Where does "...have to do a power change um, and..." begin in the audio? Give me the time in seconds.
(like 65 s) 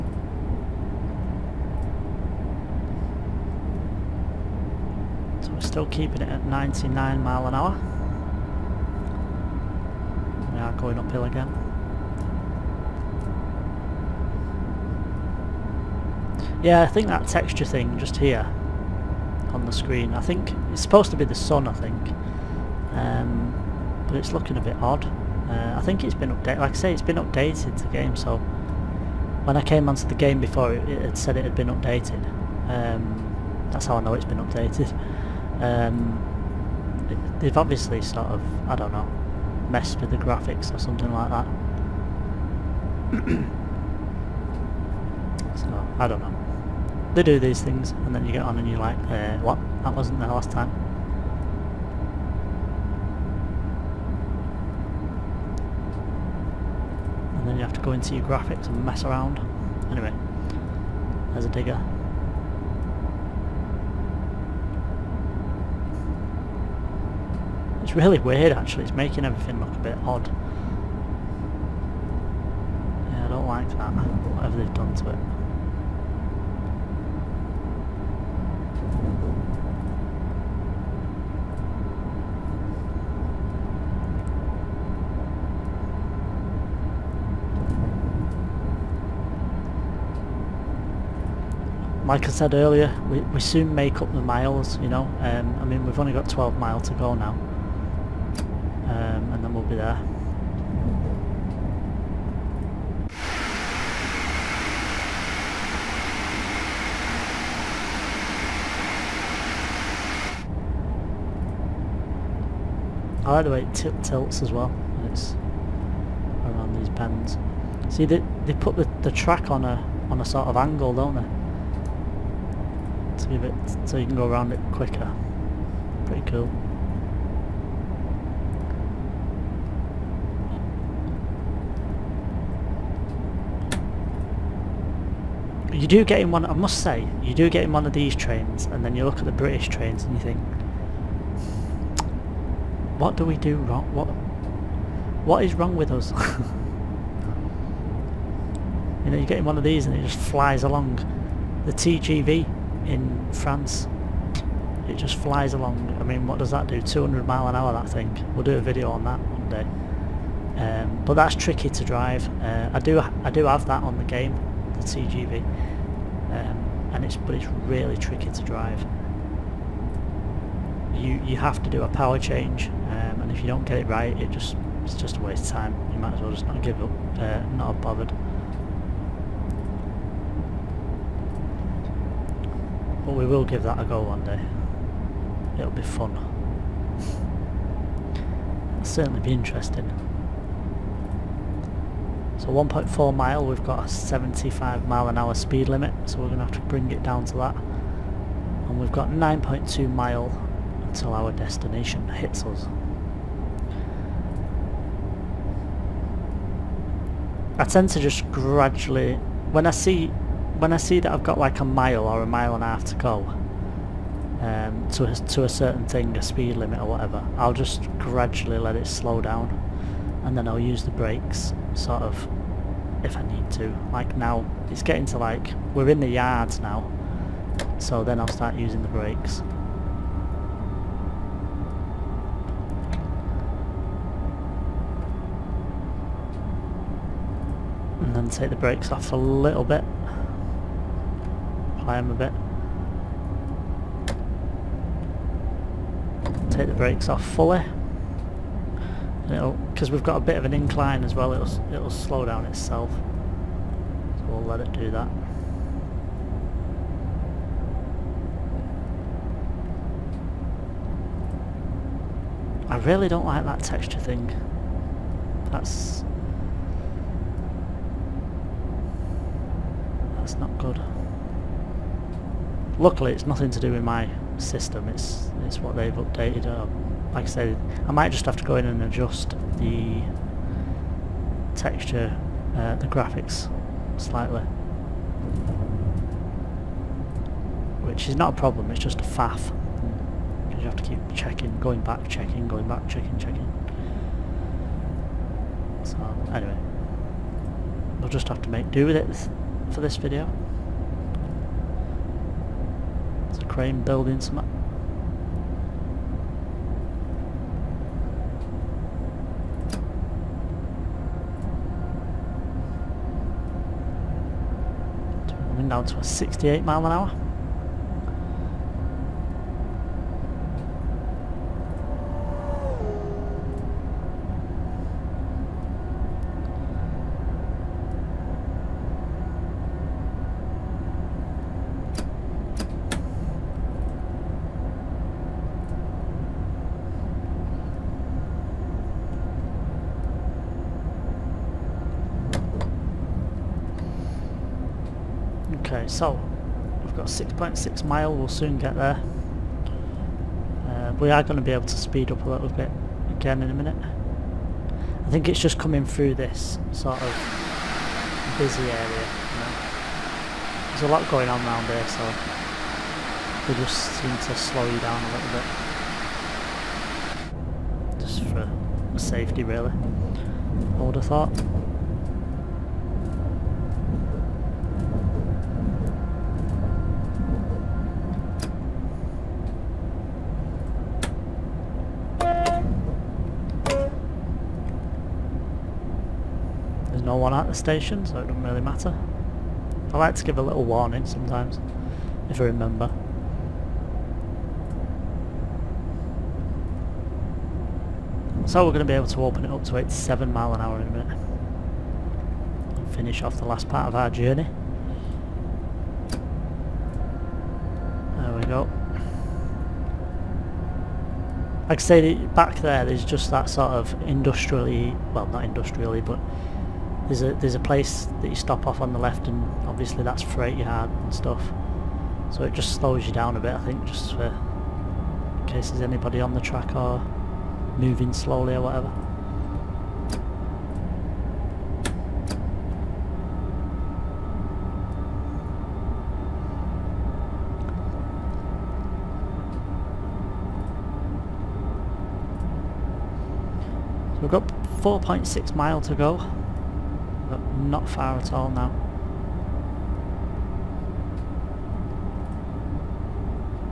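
171 s.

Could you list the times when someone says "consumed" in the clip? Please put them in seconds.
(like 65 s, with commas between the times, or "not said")
not said.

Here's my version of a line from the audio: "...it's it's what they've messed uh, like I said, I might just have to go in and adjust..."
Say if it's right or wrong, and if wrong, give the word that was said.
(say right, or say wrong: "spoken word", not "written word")
wrong: "updated", not "messed".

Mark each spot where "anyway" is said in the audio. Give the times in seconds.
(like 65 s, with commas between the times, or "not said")
59 s, 296 s.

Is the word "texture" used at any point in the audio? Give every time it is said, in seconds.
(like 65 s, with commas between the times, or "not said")
17 s, 263 s, 281 s.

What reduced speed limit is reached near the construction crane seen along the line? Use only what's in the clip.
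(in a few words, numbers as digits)
68 mph.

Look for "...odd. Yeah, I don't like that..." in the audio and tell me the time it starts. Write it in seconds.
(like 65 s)
70 s.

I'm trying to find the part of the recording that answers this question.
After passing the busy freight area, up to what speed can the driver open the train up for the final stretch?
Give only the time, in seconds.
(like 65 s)
399 s.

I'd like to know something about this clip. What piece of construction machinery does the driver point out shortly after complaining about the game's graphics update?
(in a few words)
digger.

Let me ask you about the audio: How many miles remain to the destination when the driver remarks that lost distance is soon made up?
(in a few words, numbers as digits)
12.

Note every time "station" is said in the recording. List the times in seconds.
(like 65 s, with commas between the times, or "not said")
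387 s.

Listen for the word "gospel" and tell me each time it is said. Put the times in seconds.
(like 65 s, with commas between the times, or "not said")
not said.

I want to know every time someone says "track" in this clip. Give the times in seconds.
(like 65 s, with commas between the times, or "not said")
119 s, 426 s.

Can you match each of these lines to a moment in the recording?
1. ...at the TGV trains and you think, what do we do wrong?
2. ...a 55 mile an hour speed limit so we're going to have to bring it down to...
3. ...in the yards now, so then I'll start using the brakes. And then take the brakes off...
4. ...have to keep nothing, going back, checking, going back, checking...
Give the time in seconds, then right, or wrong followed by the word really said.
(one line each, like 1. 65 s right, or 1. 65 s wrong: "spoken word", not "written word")
1. 139 s wrong: "British", not "TGV"
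2. 193 s wrong: "75", not "55"
3. 225 s right
4. 290 s wrong: "checking", not "nothing".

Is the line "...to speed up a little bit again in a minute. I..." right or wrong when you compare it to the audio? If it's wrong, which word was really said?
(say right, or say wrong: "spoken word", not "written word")
right.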